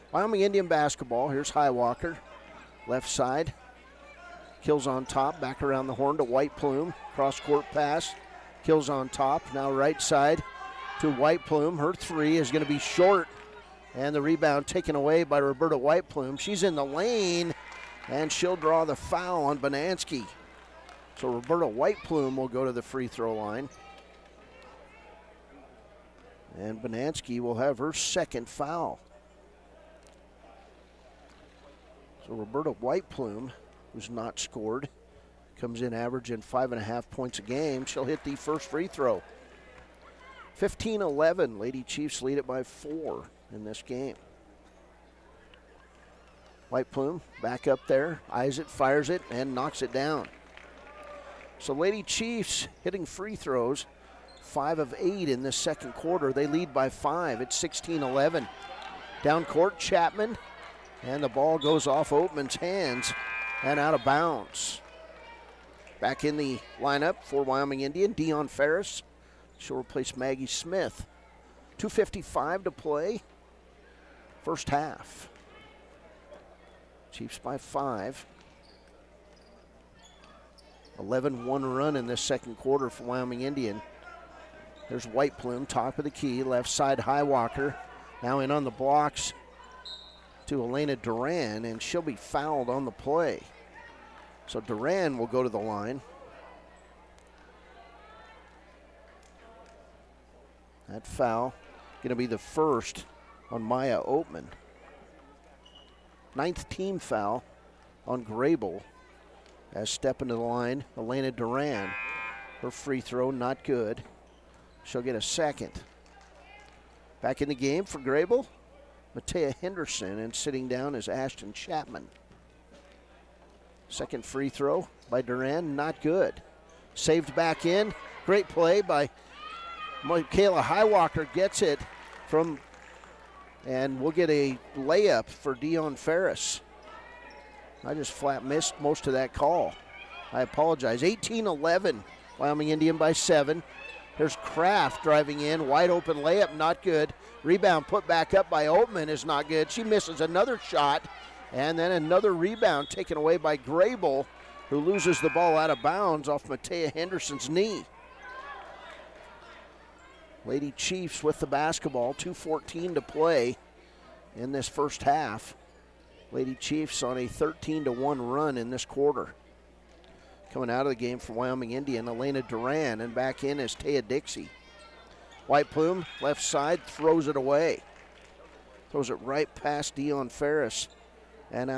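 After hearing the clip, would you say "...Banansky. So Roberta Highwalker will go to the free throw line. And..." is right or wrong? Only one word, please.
wrong.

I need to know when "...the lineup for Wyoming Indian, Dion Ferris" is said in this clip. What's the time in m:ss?
1:06.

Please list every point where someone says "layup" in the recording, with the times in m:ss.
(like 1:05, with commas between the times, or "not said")
2:14, 2:26.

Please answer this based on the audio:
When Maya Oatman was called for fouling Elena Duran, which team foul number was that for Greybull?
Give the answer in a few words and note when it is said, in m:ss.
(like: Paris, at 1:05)
9th, at 1:46.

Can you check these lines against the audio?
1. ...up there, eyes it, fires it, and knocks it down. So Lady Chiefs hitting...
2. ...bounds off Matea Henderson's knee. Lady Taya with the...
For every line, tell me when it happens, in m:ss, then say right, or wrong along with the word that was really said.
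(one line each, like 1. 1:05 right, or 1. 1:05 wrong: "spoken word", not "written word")
1. 0:47 right
2. 2:35 wrong: "Chiefs", not "Taya".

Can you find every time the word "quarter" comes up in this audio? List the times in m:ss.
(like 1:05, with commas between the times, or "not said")
0:55, 1:22, 2:48.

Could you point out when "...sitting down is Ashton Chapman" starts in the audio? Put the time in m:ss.
2:00.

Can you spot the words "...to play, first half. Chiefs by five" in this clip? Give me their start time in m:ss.
1:12.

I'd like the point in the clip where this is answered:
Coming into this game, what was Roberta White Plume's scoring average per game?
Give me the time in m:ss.
0:36.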